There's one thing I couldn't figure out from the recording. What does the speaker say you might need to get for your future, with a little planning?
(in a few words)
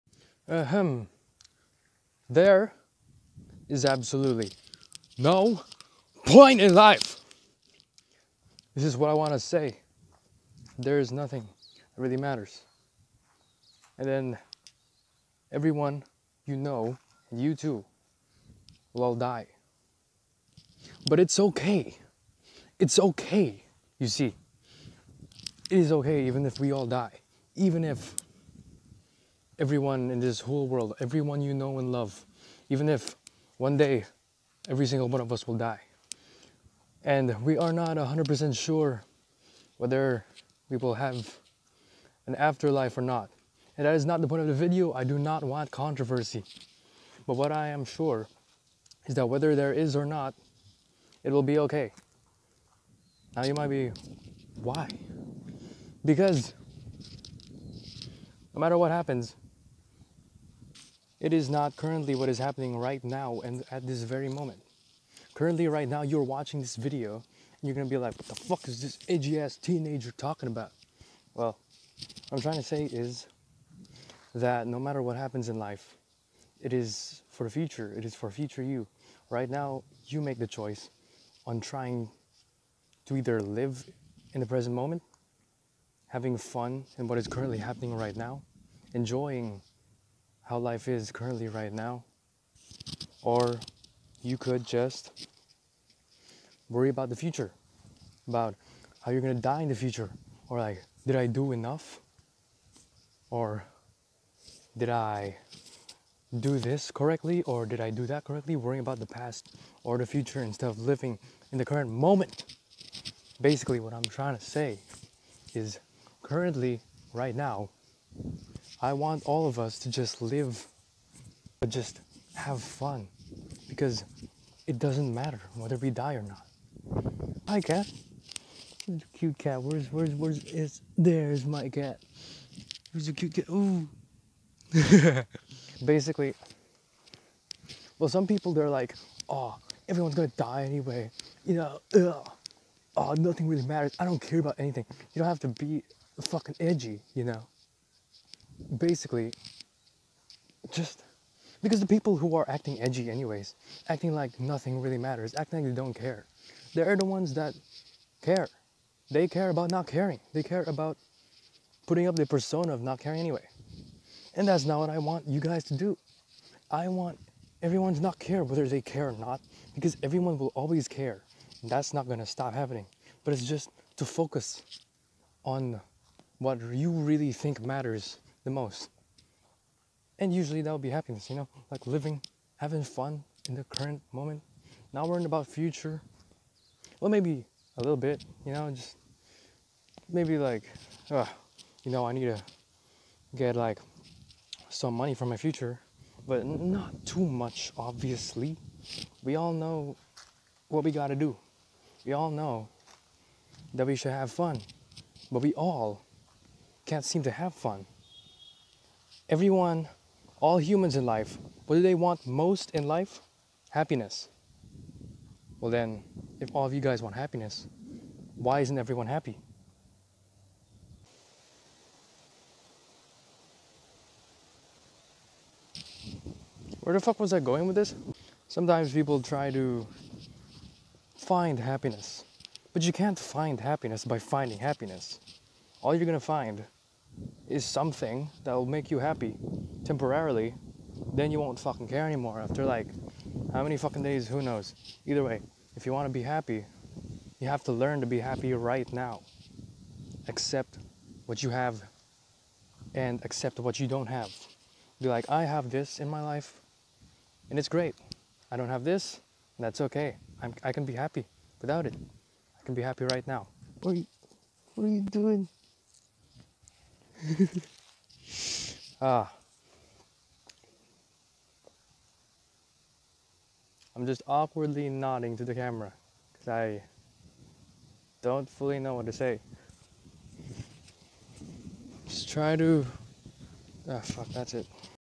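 money.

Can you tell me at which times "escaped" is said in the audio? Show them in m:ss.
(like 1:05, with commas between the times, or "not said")
not said.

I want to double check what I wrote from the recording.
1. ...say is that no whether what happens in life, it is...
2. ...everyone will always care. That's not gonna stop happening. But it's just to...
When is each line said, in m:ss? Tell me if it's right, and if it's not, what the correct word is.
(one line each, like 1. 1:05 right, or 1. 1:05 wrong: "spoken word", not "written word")
1. 1:12 wrong: "matter", not "whether"
2. 2:50 right.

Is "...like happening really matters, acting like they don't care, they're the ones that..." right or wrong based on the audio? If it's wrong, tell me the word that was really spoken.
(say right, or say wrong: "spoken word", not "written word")
wrong: "nothing", not "happening".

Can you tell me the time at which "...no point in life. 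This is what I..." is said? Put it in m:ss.
0:05.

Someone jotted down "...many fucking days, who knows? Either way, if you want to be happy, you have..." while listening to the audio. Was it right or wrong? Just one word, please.
right.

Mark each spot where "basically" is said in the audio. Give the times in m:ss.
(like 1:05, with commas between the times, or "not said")
1:53, 2:15, 2:28.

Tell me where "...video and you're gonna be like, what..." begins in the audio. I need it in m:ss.
1:06.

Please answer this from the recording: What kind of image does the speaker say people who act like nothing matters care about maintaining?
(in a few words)
persona.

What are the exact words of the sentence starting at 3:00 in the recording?
And usually that would be happiness, you know, like living, having fun in the current moment, not worrying about future.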